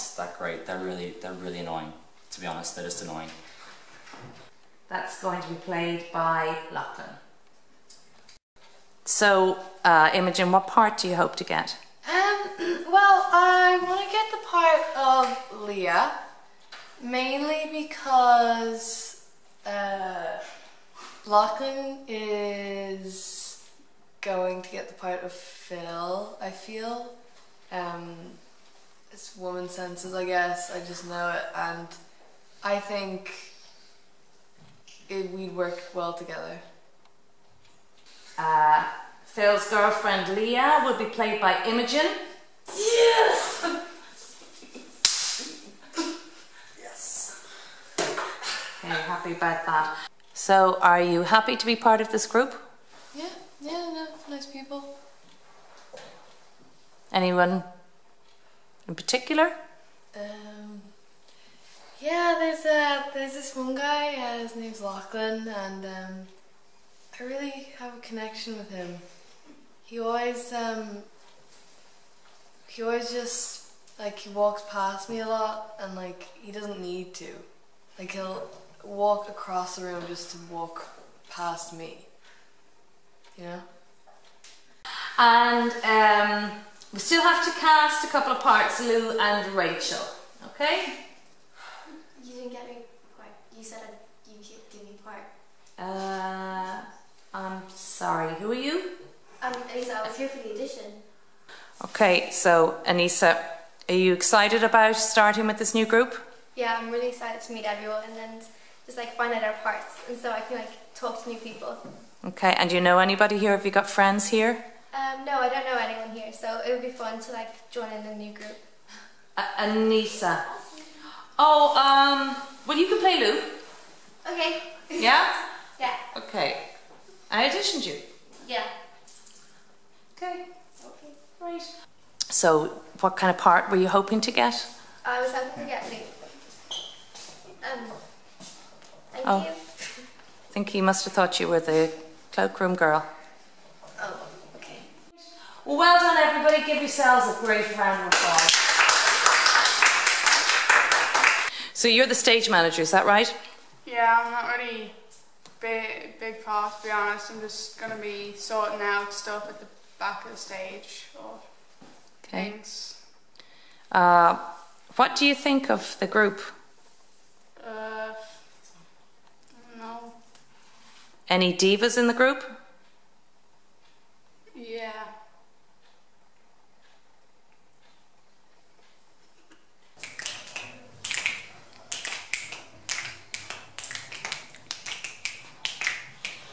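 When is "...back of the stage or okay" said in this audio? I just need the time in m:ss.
2:39.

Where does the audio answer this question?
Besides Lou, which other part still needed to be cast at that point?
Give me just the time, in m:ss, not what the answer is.
1:29.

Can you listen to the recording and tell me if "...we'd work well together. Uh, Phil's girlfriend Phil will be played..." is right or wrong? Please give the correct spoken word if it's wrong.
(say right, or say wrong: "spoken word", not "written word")
wrong: "Leah", not "Phil".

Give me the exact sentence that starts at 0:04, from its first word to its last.
That's going to be played by Lachlan.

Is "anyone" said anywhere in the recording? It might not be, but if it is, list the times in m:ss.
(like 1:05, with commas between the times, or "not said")
0:57, 1:55.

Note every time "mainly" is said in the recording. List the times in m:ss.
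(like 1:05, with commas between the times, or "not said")
0:17.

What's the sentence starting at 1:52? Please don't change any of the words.
Okay, and do you know anybody here?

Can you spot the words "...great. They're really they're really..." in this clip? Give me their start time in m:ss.
0:00.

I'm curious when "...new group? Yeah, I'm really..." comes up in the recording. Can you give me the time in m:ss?
1:45.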